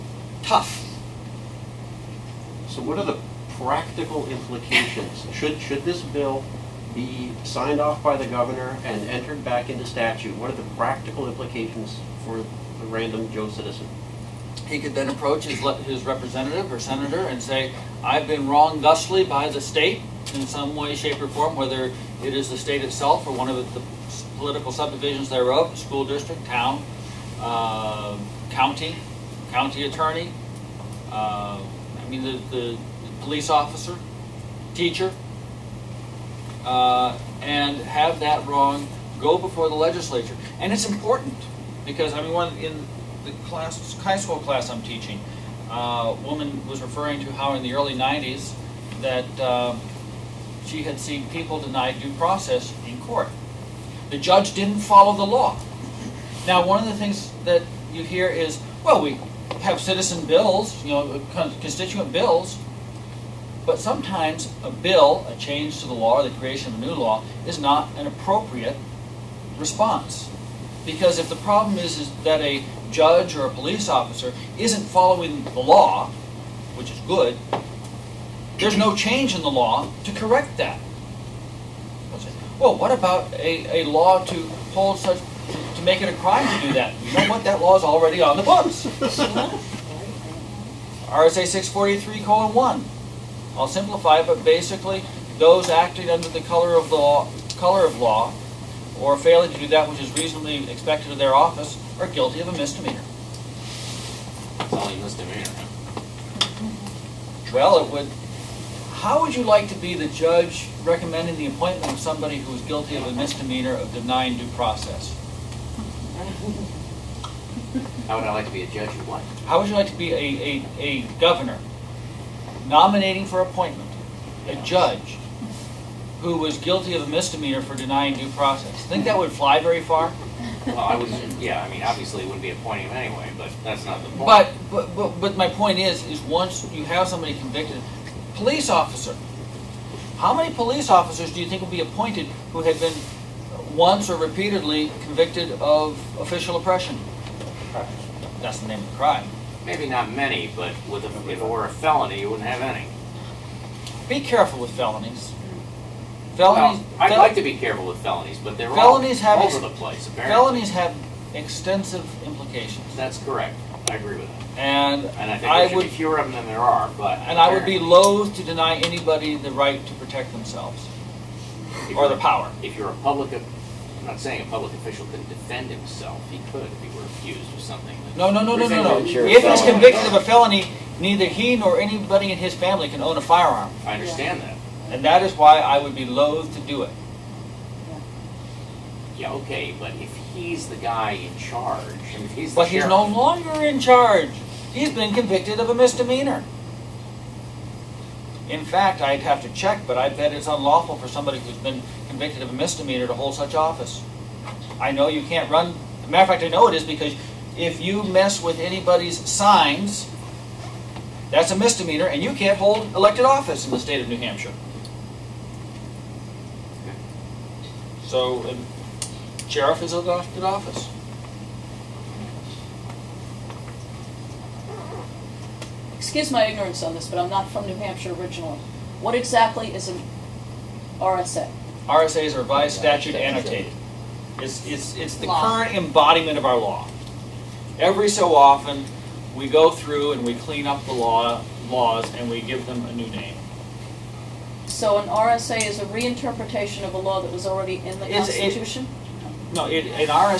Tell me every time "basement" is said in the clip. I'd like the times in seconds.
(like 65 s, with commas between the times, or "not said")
not said.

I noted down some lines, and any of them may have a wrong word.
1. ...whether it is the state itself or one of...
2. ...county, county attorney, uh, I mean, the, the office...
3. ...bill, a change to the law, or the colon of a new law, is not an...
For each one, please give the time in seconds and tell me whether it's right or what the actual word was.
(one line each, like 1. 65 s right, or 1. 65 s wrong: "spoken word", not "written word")
1. 21 s right
2. 28 s wrong: "police", not "office"
3. 64 s wrong: "creation", not "colon".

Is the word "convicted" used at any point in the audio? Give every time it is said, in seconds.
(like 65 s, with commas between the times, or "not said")
137 s, 145 s, 179 s, 195 s, 202 s.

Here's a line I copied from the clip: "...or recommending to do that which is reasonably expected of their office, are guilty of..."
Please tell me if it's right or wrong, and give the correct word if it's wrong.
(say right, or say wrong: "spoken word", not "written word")
wrong: "failing", not "recommending".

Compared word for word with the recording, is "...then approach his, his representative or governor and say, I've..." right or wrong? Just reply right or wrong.
wrong.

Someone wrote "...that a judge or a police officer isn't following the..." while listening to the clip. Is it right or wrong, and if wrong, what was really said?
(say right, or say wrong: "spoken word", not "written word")
right.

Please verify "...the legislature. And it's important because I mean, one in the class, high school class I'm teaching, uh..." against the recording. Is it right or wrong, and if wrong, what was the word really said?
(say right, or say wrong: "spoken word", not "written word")
right.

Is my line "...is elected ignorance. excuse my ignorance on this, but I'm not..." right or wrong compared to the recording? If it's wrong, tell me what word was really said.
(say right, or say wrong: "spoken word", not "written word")
wrong: "office", not "ignorance".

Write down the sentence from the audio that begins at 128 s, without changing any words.
Think that would fly very far?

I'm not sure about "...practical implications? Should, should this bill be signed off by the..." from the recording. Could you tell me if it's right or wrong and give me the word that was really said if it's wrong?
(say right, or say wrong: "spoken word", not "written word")
right.